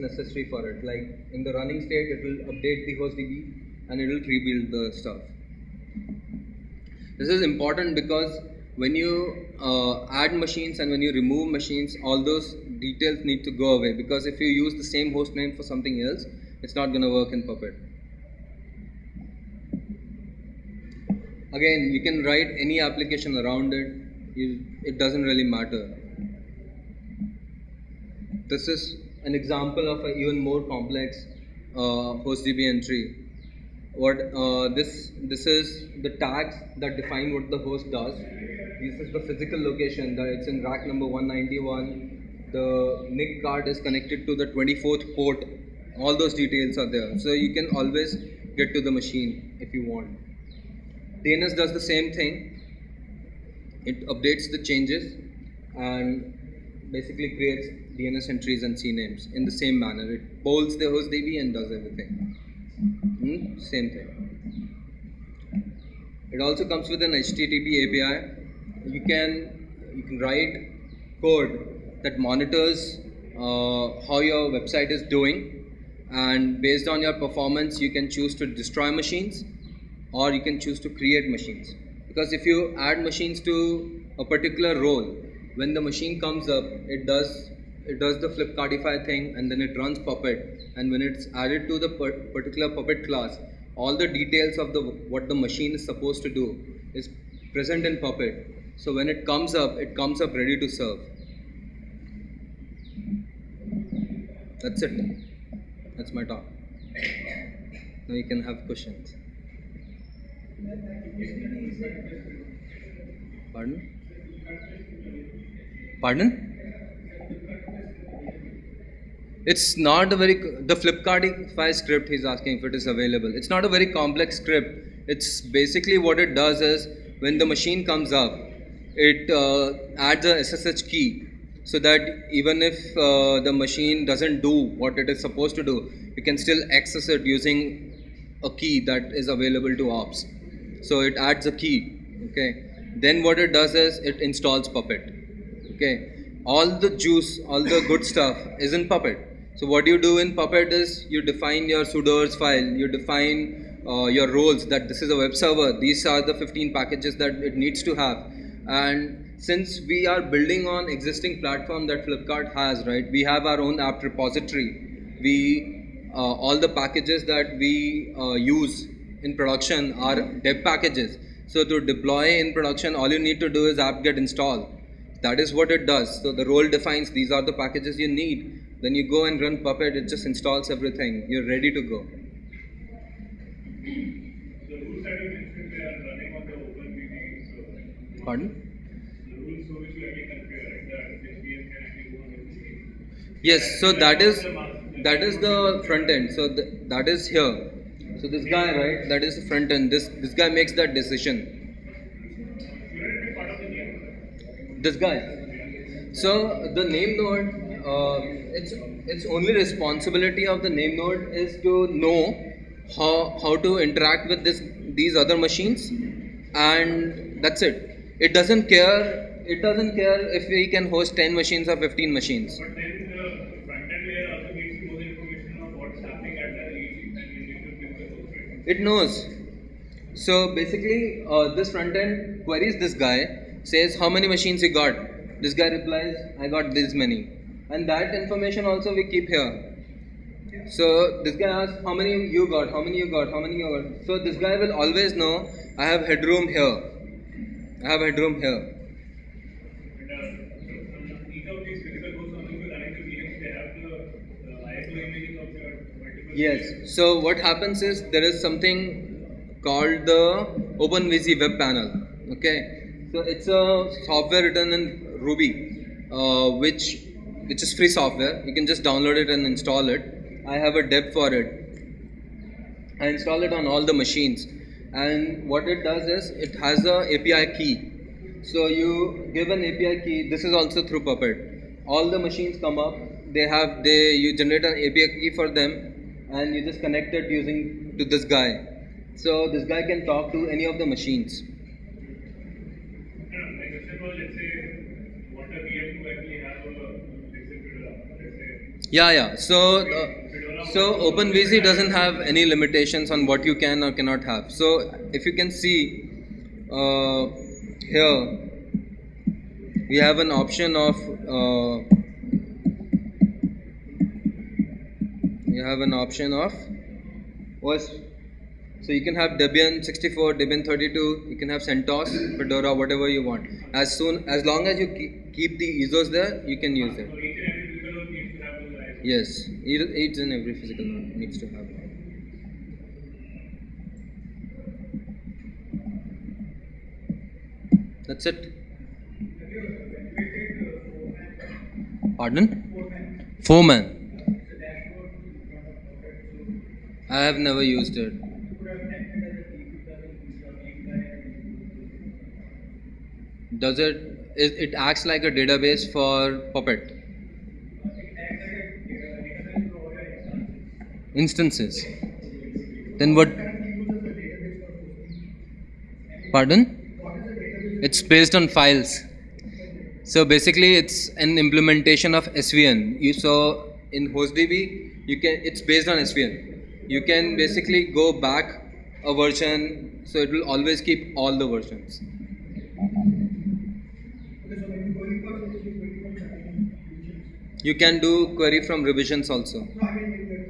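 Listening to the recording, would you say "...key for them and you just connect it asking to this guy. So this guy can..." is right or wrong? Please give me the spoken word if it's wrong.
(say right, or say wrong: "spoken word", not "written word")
wrong: "using", not "asking".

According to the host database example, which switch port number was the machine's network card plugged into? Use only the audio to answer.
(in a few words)
24.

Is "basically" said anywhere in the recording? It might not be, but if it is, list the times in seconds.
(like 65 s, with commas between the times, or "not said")
56 s, 125 s, 230 s, 370 s, 377 s.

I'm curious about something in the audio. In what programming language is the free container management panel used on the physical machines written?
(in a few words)
Ruby.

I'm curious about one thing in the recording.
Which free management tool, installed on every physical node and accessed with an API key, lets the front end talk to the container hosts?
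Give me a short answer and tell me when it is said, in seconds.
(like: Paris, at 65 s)
OpenVZ web panel, at 260 s.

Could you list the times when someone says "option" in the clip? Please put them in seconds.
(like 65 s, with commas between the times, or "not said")
310 s, 316 s.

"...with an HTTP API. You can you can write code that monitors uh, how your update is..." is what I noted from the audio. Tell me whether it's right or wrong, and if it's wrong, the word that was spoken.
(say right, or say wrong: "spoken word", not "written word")
wrong: "website", not "update".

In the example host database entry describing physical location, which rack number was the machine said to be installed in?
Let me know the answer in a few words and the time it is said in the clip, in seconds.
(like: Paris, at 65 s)
191, at 40 s.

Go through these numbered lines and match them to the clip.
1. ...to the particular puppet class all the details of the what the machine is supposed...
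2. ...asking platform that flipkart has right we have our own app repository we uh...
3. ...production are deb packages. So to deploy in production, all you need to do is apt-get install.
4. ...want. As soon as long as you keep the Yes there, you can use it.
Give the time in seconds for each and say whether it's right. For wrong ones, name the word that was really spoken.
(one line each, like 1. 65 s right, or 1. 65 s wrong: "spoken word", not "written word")
1. 91 s right
2. 160 s wrong: "existing", not "asking"
3. 169 s right
4. 323 s wrong: "ISOs", not "Yes".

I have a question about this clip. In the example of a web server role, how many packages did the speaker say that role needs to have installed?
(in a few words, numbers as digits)
15.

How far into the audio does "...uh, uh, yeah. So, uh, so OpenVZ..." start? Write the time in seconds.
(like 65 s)
299 s.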